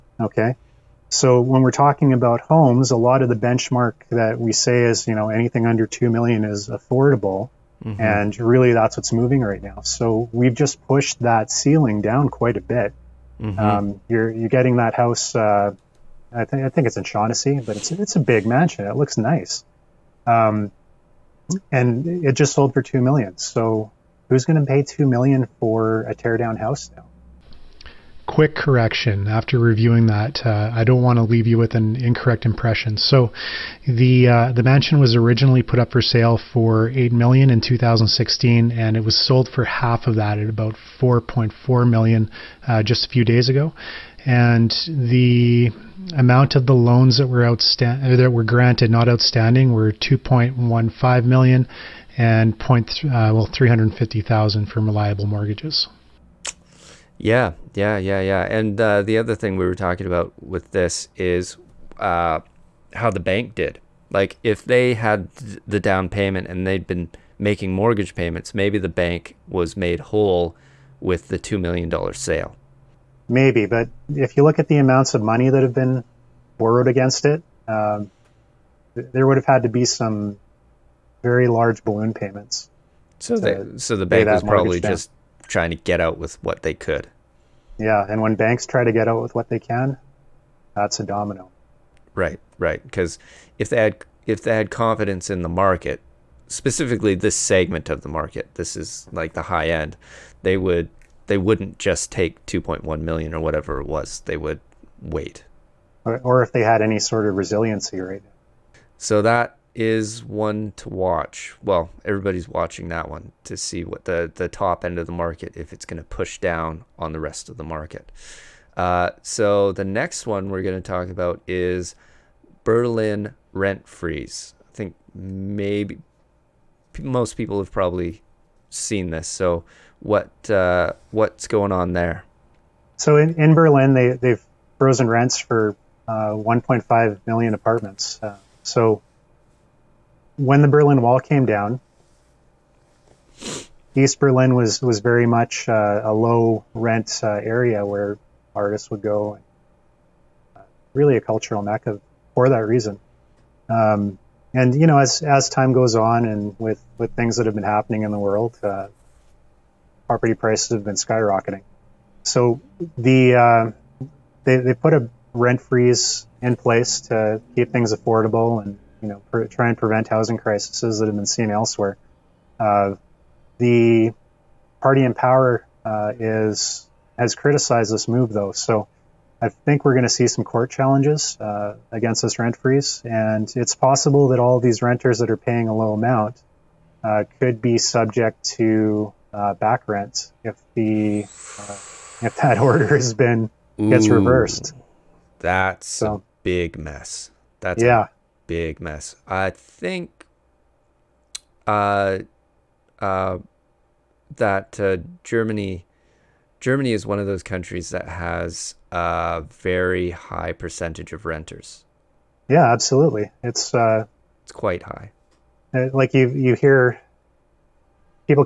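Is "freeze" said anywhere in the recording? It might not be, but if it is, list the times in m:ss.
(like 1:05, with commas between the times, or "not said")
2:03, 2:45, 3:02.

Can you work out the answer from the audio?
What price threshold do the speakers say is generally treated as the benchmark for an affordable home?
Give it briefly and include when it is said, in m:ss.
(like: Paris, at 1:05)
under 2 million, at 0:05.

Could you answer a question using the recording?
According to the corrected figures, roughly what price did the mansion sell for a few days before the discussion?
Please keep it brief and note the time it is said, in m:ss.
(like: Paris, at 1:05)
4.4 million, at 0:40.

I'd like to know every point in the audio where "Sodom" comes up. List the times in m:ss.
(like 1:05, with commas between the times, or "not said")
not said.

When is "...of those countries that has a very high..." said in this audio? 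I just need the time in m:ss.
3:27.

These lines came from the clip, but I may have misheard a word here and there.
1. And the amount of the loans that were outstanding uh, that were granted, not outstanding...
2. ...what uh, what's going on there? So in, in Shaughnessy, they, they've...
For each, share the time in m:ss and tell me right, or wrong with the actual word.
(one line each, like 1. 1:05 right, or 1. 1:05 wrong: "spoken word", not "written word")
1. 0:44 right
2. 2:09 wrong: "Berlin", not "Shaughnessy".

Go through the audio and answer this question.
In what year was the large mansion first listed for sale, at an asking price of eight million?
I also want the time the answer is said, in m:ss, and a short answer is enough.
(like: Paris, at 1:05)
2016, at 0:37.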